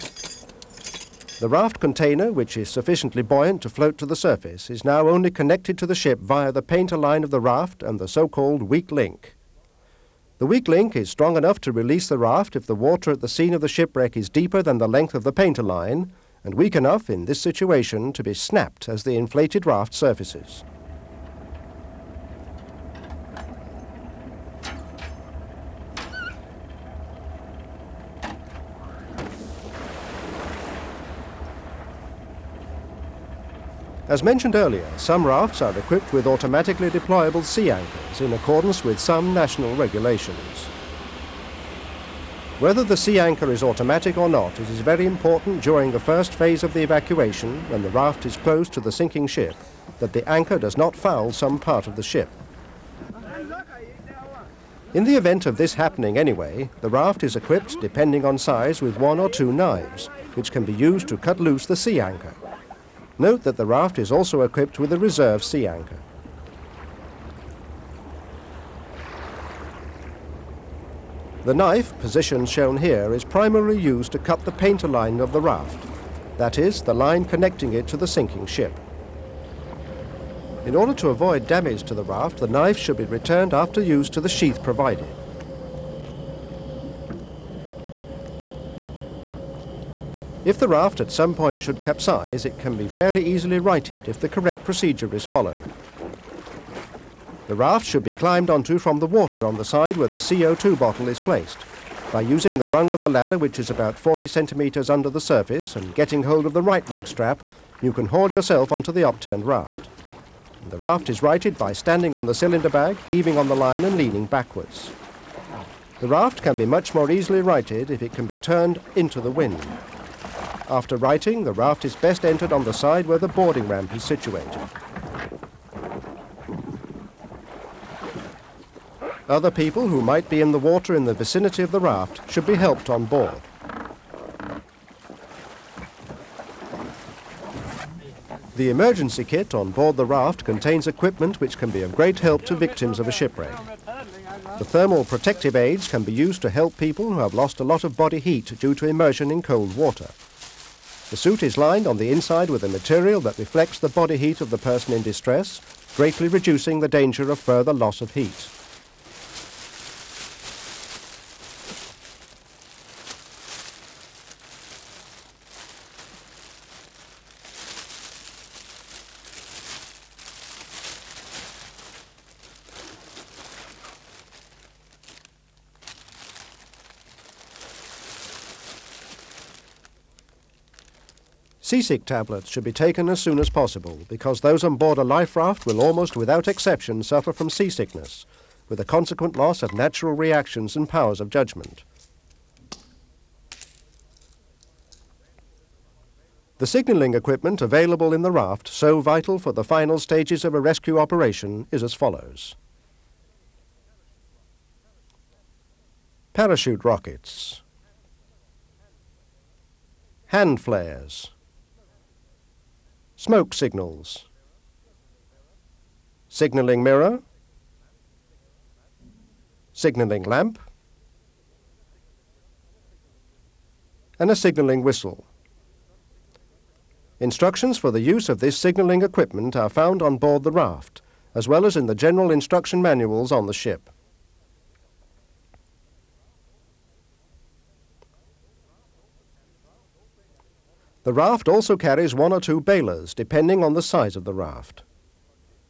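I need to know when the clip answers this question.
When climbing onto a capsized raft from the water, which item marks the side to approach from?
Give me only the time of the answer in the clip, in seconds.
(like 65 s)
100 s.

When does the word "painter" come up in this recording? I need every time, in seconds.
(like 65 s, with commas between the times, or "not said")
6 s, 15 s, 74 s.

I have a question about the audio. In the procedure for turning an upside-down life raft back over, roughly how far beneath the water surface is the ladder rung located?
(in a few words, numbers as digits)
40 centimetres.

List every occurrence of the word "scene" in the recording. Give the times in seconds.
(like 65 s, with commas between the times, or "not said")
13 s.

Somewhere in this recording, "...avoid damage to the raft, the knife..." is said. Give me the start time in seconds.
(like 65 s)
81 s.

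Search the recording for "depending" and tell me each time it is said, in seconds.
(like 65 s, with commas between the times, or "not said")
57 s, 243 s.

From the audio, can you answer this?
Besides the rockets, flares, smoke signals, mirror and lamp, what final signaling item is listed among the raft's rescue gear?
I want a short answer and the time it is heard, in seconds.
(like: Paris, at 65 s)
signaling whistle, at 224 s.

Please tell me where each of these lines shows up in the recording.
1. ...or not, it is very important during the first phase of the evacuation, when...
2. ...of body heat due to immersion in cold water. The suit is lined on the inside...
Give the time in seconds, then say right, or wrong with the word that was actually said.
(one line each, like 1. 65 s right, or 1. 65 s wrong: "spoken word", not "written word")
1. 44 s right
2. 147 s right.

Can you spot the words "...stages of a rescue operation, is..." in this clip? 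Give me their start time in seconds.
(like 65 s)
199 s.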